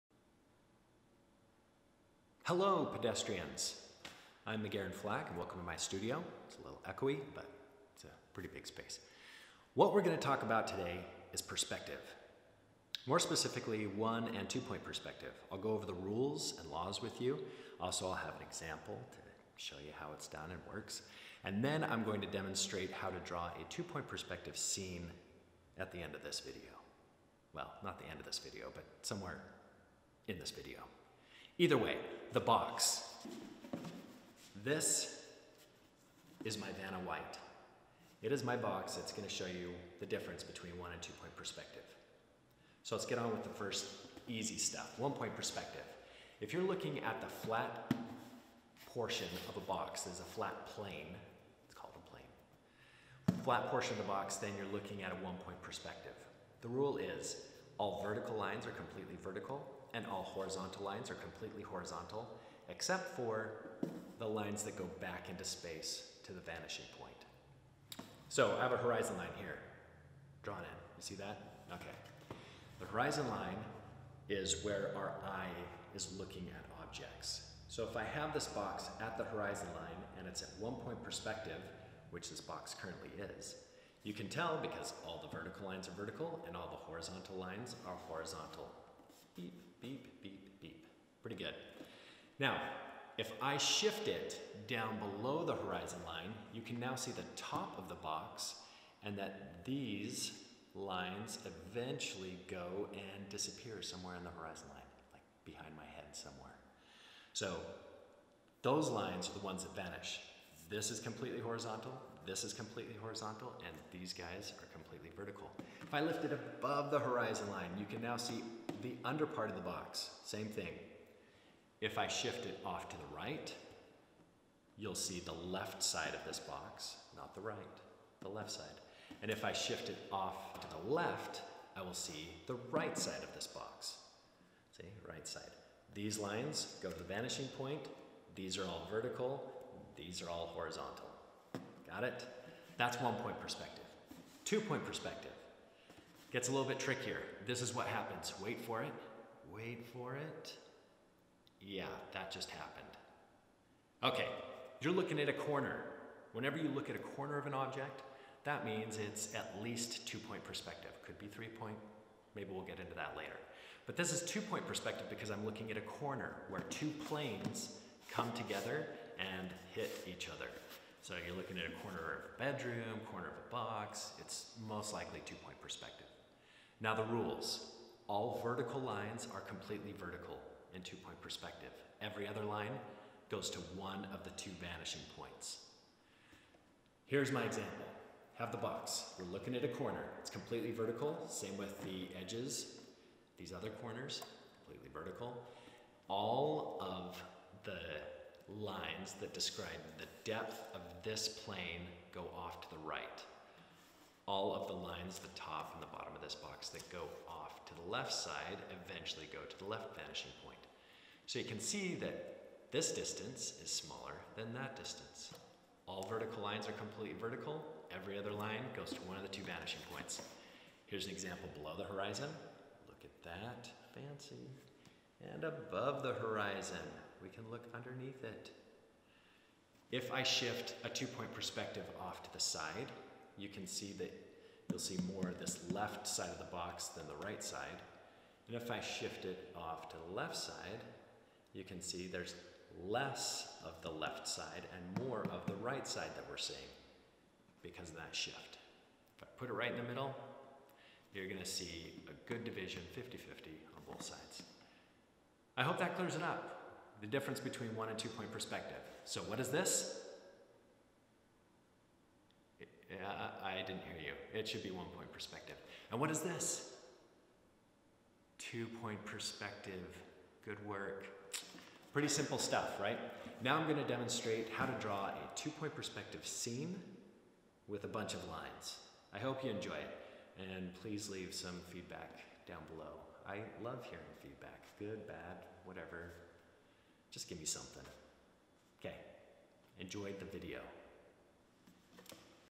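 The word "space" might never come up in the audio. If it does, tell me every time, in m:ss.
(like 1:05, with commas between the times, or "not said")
0:08, 1:05.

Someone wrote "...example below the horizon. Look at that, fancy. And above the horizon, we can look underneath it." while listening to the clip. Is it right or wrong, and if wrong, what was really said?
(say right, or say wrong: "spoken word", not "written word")
right.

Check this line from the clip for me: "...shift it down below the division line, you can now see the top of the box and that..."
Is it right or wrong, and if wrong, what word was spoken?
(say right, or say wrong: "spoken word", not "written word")
wrong: "horizon", not "division".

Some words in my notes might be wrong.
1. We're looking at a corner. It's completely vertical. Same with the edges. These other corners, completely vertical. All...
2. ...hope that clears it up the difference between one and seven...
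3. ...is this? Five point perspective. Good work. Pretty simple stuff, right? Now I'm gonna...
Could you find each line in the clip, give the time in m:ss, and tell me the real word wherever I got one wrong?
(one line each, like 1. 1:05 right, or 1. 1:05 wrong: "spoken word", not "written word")
1. 3:09 right
2. 4:15 wrong: "two", not "seven"
3. 4:26 wrong: "Two", not "Five".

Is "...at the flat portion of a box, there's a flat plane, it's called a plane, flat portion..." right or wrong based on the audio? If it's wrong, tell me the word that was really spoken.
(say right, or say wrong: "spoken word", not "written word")
right.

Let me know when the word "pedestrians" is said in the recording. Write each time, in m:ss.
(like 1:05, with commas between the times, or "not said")
0:02.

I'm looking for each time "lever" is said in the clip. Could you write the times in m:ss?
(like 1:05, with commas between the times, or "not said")
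not said.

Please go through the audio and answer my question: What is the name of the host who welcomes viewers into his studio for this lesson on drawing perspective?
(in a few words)
McGarren Flack.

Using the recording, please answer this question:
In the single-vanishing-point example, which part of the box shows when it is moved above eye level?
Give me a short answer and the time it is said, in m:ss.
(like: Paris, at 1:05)
the under part, at 1:58.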